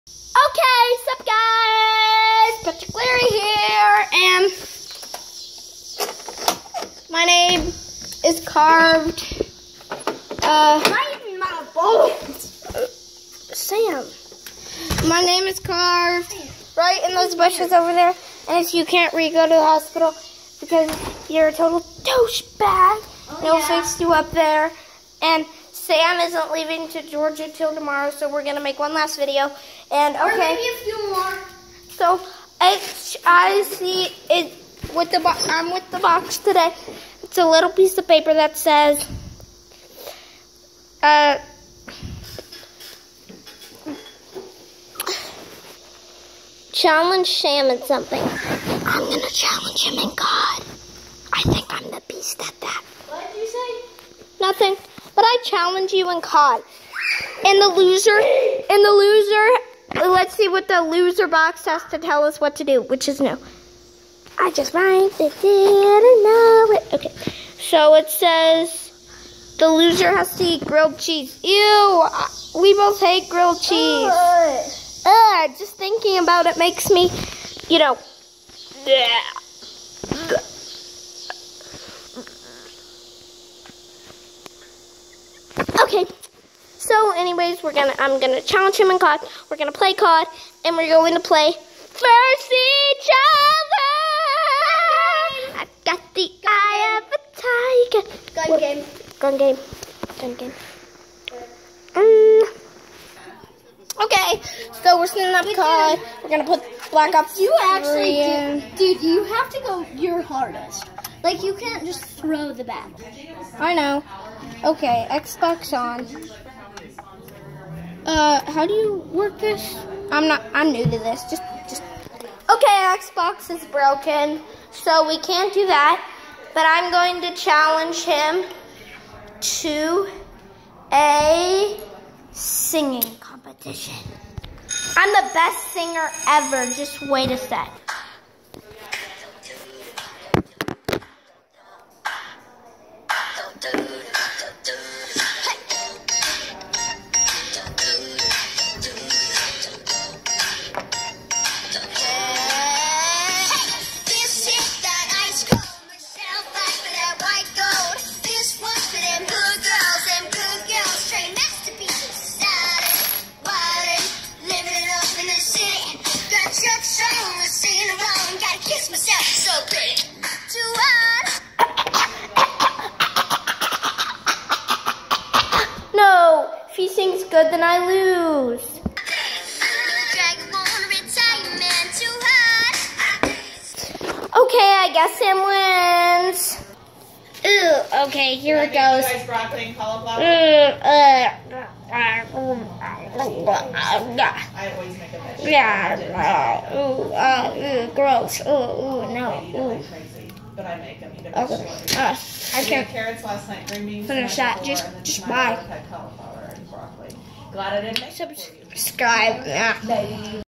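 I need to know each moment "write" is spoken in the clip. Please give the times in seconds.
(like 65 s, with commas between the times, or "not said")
64 s.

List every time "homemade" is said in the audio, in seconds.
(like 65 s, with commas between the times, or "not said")
not said.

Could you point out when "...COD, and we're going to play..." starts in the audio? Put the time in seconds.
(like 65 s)
89 s.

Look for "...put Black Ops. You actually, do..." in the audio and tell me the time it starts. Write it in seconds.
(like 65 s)
106 s.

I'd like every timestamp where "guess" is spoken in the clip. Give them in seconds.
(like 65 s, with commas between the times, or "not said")
184 s.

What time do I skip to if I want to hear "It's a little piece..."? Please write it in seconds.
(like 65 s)
37 s.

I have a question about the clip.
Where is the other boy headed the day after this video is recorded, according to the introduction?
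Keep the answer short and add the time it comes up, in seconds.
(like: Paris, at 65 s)
Georgia, at 27 s.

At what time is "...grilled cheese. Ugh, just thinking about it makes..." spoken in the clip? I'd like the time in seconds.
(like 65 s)
73 s.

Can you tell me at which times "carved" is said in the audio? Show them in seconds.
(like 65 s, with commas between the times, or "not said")
8 s, 15 s.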